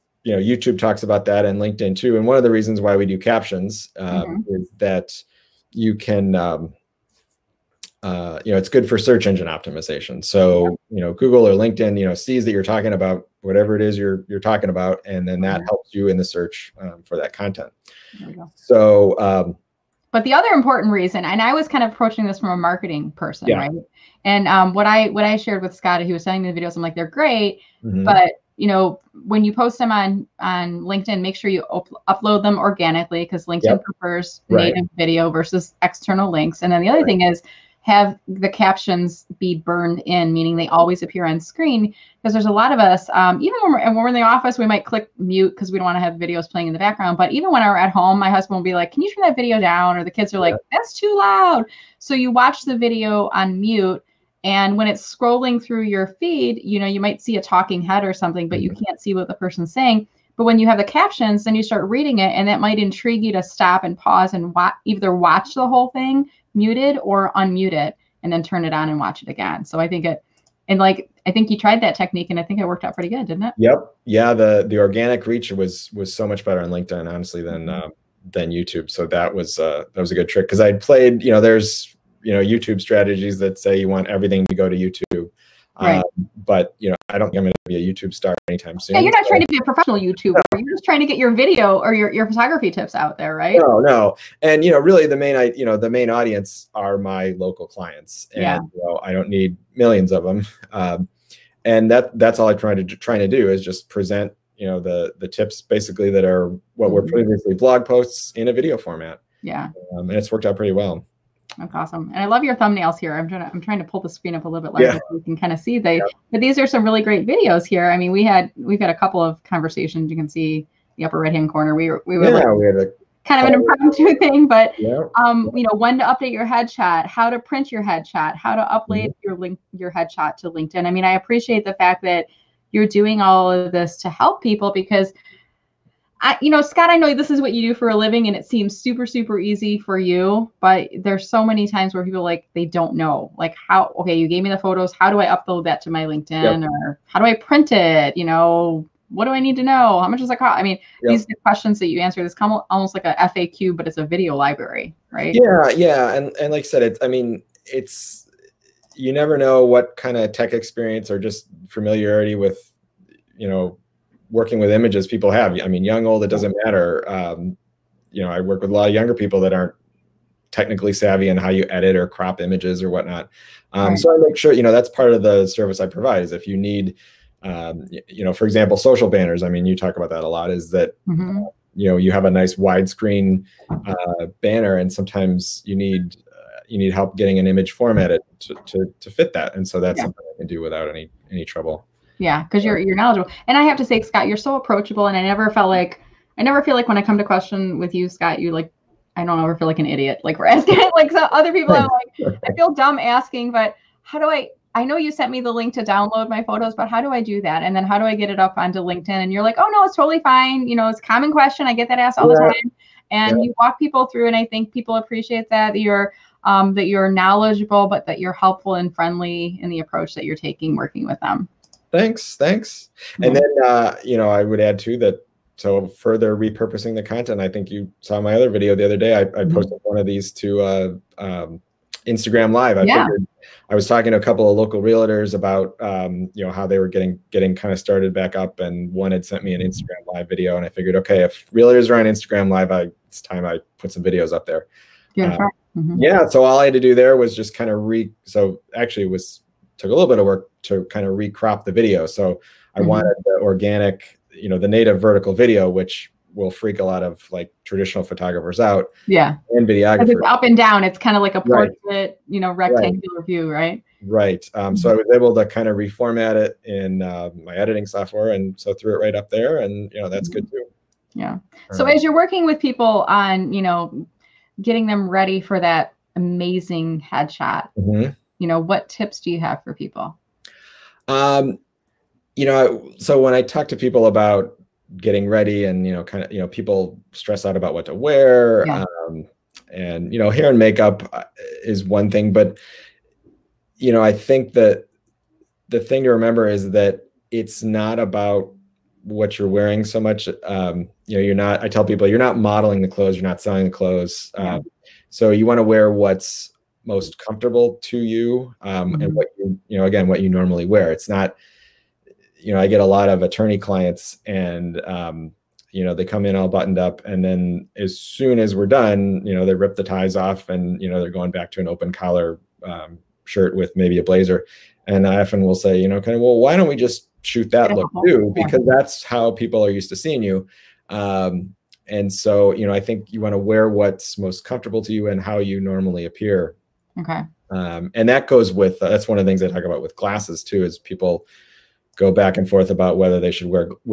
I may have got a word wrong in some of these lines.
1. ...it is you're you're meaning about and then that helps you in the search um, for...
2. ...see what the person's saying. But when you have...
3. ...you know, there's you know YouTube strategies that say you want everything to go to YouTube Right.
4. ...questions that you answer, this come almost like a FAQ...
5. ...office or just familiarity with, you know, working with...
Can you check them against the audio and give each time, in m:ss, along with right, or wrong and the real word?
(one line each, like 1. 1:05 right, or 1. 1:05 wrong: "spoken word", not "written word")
1. 0:13 wrong: "talking", not "meaning"
2. 0:58 right
3. 1:21 right
4. 2:31 right
5. 2:40 wrong: "experience", not "office".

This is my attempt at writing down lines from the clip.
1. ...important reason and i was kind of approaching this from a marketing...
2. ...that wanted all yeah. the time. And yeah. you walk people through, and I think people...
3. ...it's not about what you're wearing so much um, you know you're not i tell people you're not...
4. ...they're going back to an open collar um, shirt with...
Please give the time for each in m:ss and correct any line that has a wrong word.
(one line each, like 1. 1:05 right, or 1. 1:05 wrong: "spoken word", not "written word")
1. 0:20 right
2. 3:31 wrong: "asked", not "wanted"
3. 4:57 right
4. 5:20 right.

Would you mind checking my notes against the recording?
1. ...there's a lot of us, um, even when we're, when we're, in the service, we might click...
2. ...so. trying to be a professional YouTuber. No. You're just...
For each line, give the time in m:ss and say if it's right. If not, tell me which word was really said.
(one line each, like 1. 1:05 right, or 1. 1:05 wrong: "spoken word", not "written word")
1. 0:42 wrong: "office", not "service"
2. 1:29 right.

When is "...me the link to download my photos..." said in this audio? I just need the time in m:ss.
3:25.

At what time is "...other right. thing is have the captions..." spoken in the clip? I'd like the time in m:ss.
0:36.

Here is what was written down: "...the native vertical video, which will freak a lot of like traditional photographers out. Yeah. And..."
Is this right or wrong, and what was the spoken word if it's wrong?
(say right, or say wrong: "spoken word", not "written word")
right.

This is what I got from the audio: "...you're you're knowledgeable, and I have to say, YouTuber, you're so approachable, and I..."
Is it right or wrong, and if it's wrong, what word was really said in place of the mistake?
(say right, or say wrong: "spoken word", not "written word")
wrong: "Scott", not "YouTuber".